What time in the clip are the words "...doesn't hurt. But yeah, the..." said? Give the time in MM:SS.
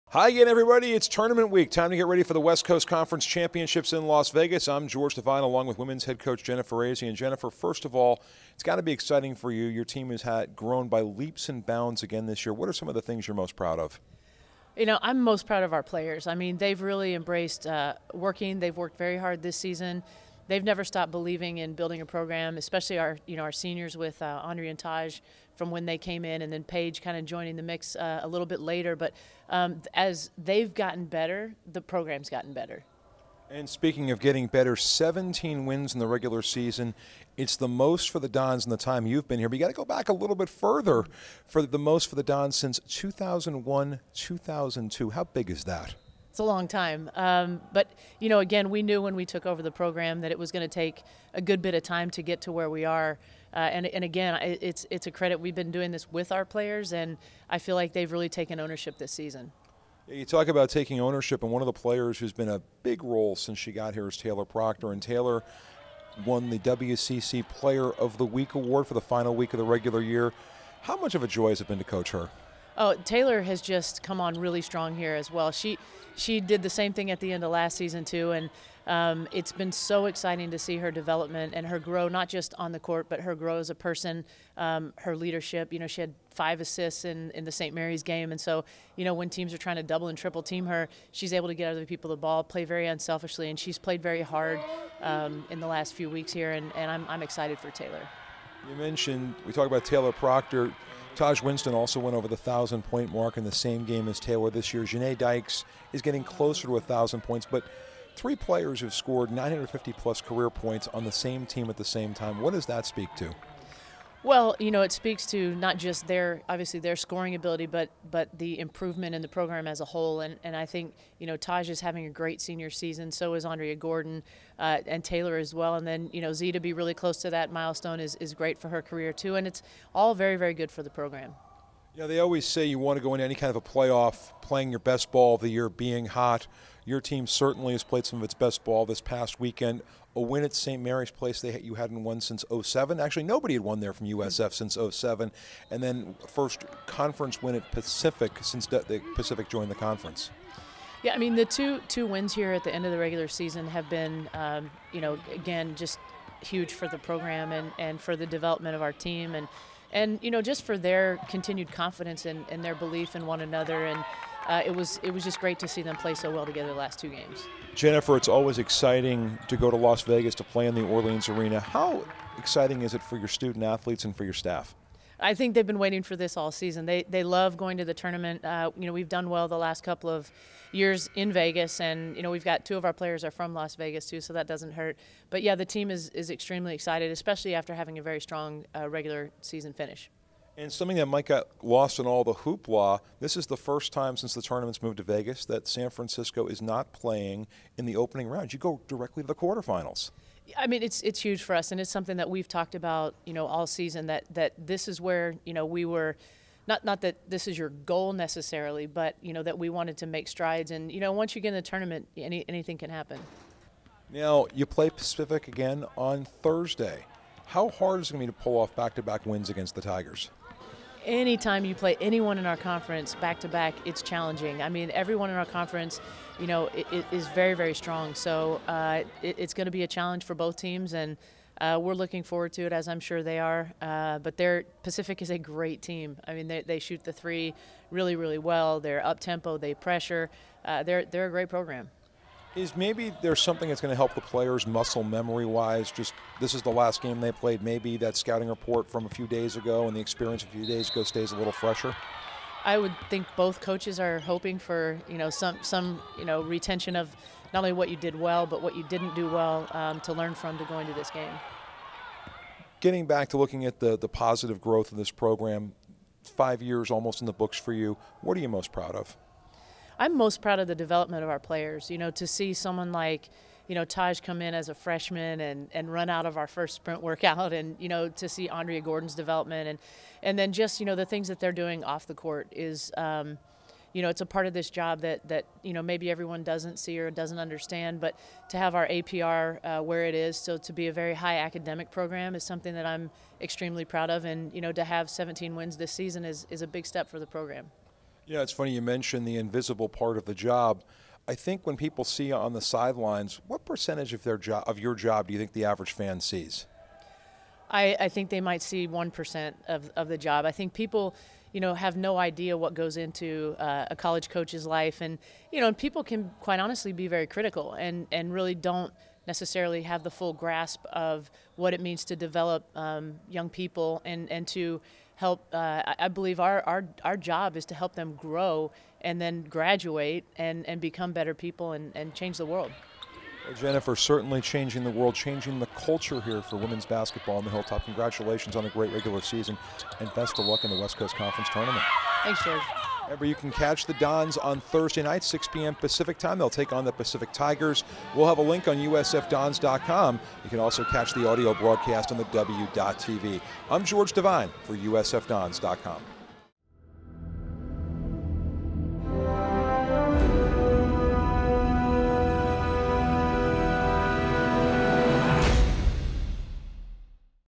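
03:04.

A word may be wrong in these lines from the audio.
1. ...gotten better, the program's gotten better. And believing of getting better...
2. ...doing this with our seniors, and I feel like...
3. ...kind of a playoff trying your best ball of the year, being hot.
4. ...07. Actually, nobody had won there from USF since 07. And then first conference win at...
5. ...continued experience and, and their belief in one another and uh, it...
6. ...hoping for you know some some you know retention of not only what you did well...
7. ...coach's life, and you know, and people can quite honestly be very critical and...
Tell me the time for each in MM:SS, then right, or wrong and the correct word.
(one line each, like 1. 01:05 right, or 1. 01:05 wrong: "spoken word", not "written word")
1. 00:30 wrong: "speaking", not "believing"
2. 00:55 wrong: "players", not "seniors"
3. 02:13 wrong: "playing", not "trying"
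4. 02:22 right
5. 02:41 wrong: "confidence", not "experience"
6. 04:14 right
7. 05:14 right.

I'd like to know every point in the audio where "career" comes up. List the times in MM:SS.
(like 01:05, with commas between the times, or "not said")
01:50, 02:08.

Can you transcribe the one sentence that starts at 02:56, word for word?
They they love going to the tournament.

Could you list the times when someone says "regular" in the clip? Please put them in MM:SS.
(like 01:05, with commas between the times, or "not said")
00:36, 01:09, 02:32, 03:08, 05:38.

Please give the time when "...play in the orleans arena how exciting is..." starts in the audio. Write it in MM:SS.
02:50.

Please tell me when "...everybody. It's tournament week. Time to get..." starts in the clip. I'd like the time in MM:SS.
00:00.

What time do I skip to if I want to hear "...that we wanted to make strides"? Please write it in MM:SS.
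03:29.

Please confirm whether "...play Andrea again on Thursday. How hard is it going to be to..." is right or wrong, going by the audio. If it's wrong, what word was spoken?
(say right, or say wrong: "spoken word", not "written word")
wrong: "Pacific", not "Andrea".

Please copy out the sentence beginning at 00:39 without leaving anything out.
But you got to go back a little bit further for the most for the Dons since 2001, 2002.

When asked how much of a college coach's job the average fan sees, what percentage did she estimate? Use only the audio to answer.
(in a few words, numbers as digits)
1 percent.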